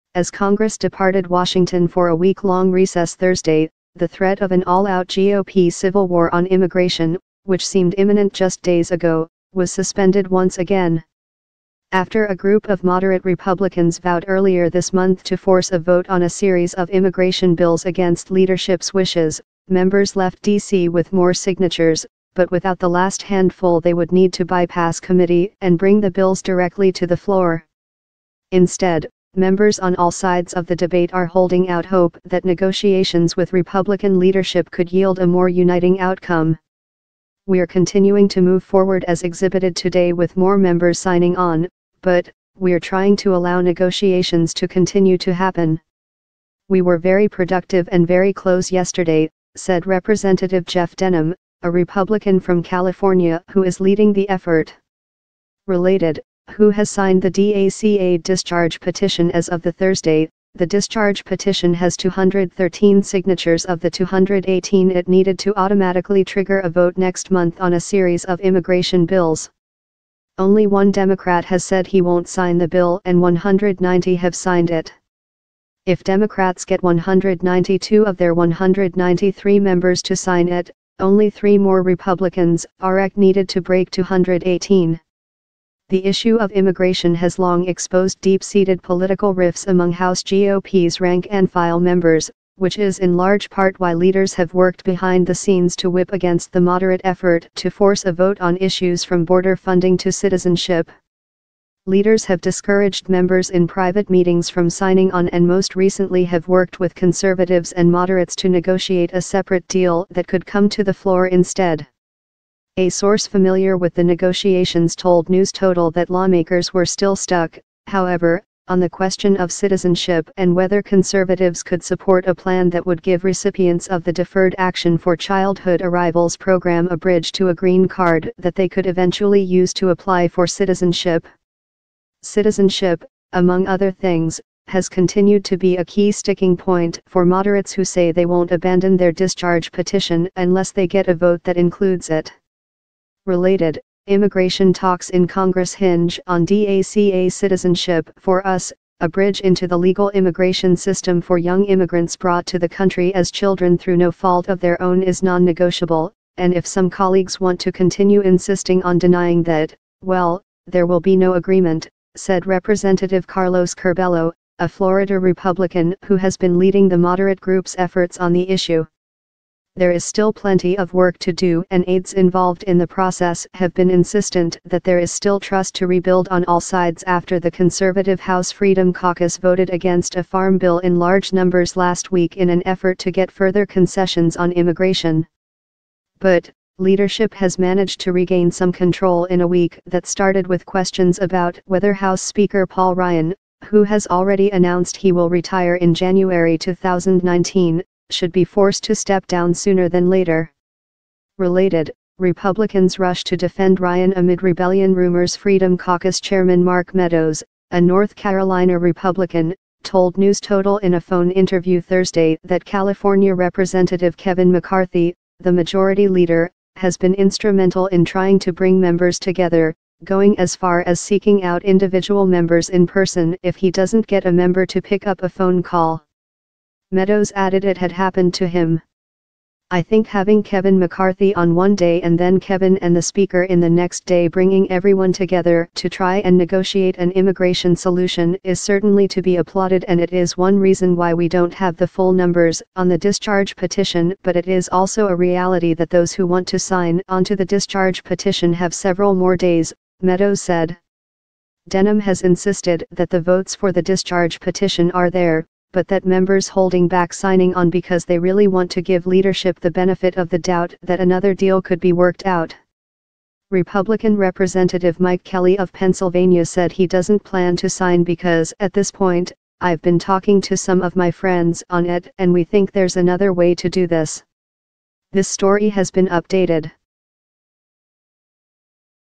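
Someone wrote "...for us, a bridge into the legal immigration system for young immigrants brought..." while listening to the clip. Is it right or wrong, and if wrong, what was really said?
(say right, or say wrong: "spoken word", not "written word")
right.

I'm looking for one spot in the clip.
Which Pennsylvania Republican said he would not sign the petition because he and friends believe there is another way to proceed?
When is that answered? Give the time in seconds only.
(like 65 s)
264 s.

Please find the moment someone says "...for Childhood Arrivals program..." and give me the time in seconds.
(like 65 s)
124 s.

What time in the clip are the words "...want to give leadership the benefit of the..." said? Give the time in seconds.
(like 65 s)
258 s.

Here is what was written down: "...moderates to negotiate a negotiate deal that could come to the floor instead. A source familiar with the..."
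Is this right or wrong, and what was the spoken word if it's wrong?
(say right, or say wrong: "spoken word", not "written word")
wrong: "separate", not "negotiate".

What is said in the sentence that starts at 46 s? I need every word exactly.
We were very productive and very close yesterday, said Representative Jeff Denham, a Republican from California who is leading the effort.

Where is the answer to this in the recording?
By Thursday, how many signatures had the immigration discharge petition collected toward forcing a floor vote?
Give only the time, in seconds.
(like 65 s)
61 s.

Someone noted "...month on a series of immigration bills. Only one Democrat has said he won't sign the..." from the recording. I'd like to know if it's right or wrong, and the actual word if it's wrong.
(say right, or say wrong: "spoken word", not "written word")
right.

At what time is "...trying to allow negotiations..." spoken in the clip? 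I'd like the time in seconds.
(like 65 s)
42 s.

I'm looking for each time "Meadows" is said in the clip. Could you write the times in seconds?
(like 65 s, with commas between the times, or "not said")
206 s, 226 s, 250 s.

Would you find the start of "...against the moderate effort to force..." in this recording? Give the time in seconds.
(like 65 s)
96 s.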